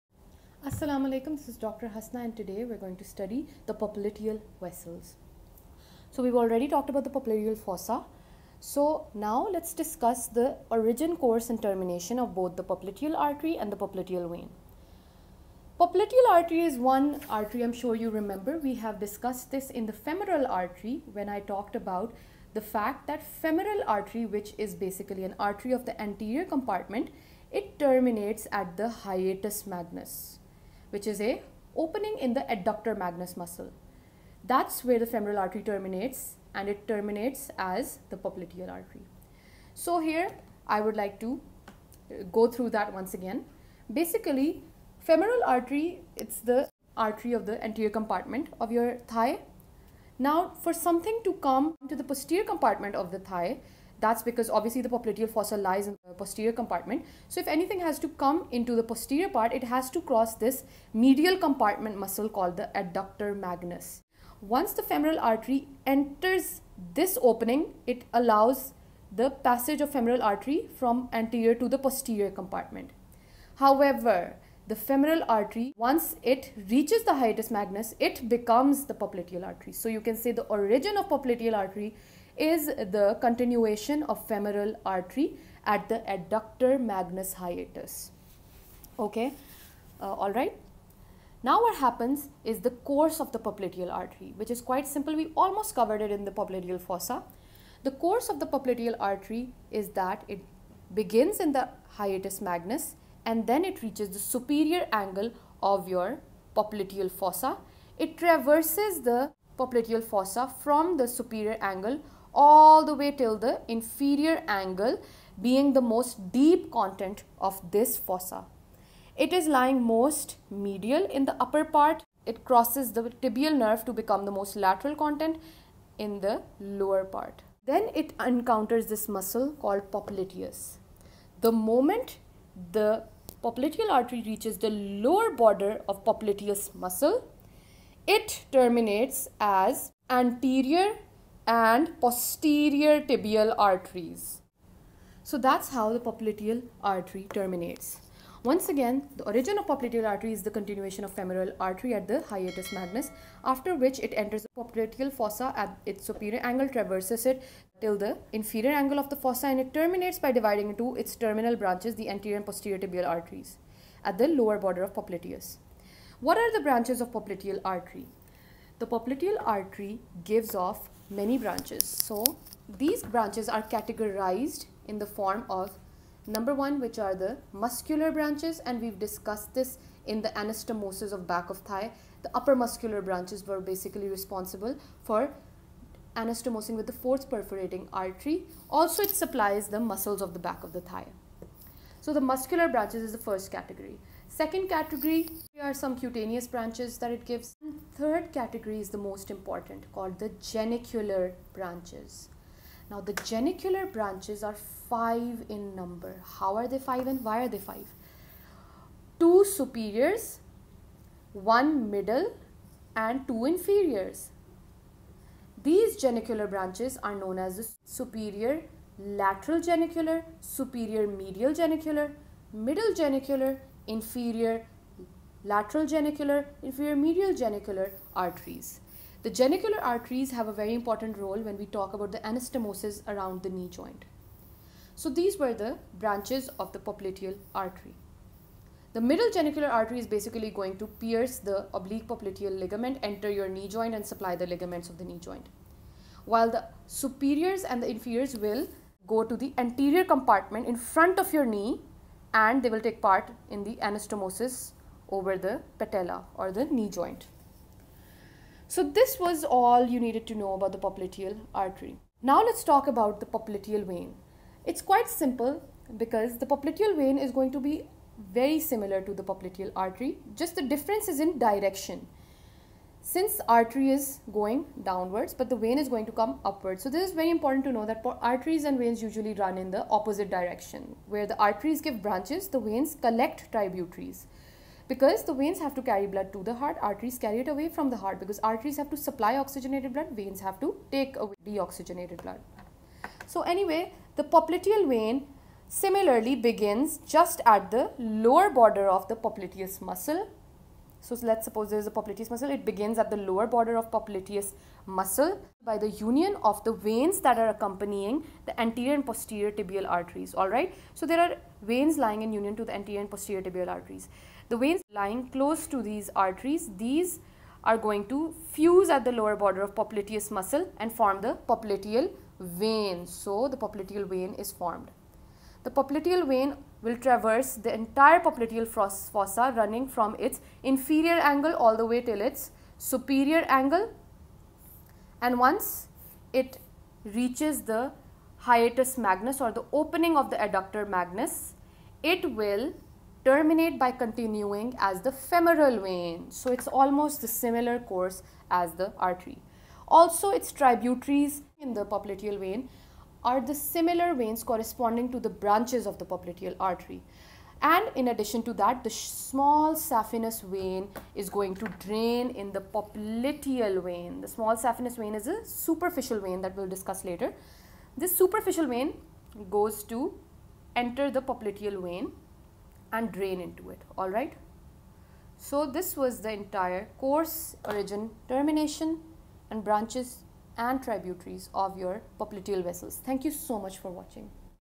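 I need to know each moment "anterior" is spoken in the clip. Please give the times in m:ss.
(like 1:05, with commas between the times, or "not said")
0:26, 0:47, 1:11, 2:20, 2:42, 4:09, 5:08, 5:12.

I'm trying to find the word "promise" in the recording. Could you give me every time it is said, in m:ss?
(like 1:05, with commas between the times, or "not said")
not said.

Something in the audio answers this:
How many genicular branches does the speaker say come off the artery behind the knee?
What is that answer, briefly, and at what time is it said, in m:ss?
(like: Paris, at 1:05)
5, at 3:24.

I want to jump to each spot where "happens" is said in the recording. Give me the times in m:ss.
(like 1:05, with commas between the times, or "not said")
1:31.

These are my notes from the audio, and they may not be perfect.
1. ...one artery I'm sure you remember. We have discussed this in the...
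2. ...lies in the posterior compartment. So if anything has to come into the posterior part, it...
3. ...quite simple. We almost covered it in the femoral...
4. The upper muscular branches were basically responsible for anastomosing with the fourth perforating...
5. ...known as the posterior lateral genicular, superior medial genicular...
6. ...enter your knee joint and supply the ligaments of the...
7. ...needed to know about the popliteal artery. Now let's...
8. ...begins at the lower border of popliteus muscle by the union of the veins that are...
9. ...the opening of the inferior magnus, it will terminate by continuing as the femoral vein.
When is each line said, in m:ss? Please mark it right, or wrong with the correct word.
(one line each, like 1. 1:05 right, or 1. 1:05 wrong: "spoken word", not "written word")
1. 0:16 right
2. 0:55 right
3. 1:34 wrong: "popliteal", not "femoral"
4. 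3:02 right
5. 3:37 wrong: "superior", not "posterior"
6. 4:03 right
7. 4:19 right
8. 5:02 right
9. 5:39 wrong: "adductor", not "inferior".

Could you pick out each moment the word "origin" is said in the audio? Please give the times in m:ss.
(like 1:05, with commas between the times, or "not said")
0:10, 1:20, 2:29, 6:17.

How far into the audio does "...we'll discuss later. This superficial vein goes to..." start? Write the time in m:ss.
6:06.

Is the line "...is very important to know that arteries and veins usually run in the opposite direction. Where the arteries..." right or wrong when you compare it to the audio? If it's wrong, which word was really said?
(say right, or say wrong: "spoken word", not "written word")
right.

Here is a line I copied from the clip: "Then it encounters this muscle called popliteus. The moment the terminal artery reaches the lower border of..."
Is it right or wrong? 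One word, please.
wrong.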